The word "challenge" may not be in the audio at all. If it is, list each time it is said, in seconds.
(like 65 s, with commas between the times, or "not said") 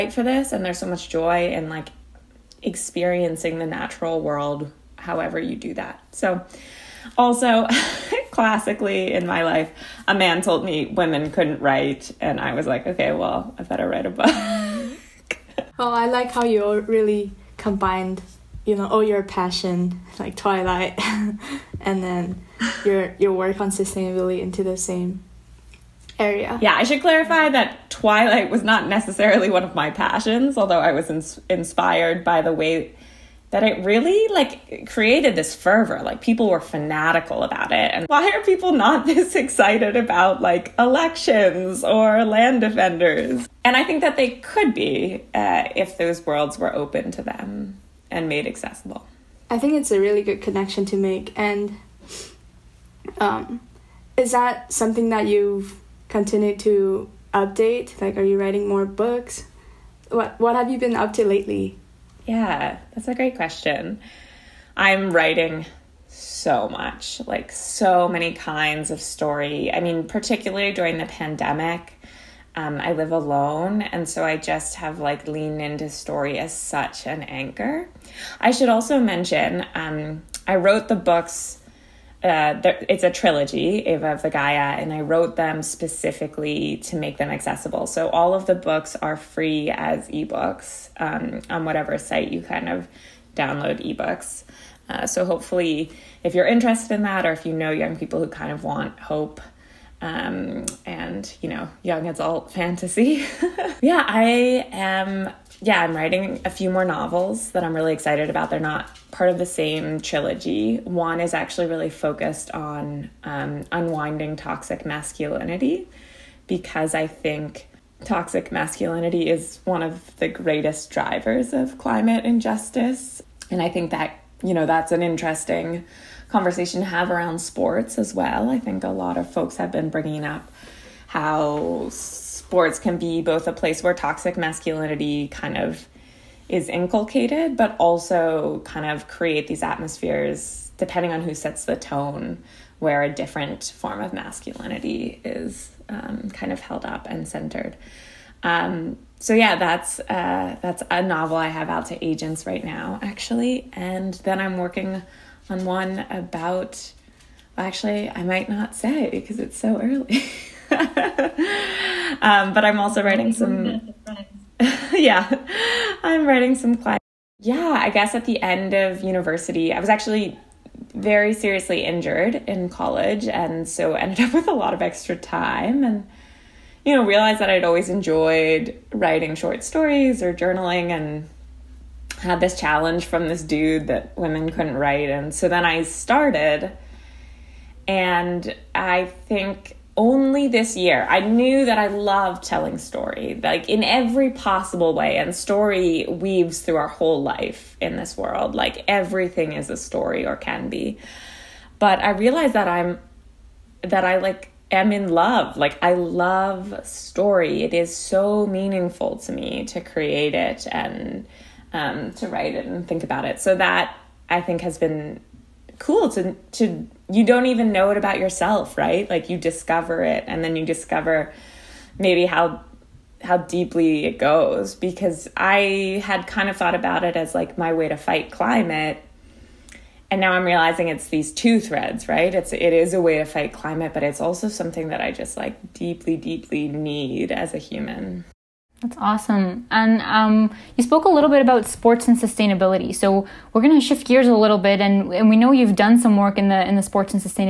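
182 s.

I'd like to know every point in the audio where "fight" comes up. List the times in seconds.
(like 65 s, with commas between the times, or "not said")
227 s, 233 s.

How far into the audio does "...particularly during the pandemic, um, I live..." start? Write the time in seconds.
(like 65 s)
70 s.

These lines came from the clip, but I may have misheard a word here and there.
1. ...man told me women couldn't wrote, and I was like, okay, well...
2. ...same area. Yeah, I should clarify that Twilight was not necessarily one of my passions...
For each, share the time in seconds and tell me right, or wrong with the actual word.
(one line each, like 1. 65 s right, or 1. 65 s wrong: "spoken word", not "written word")
1. 10 s wrong: "write", not "wrote"
2. 24 s right.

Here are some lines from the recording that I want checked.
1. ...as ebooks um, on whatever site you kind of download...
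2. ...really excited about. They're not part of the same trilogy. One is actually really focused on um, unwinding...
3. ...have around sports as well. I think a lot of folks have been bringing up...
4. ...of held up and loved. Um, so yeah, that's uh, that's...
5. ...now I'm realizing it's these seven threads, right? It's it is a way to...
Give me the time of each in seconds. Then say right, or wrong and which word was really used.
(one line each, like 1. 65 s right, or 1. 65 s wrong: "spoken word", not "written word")
1. 89 s right
2. 107 s right
3. 126 s right
4. 146 s wrong: "centered", not "loved"
5. 230 s wrong: "two", not "seven".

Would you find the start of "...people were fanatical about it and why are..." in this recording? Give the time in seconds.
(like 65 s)
36 s.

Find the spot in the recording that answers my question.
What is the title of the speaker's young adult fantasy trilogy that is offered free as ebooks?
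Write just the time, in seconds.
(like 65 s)
83 s.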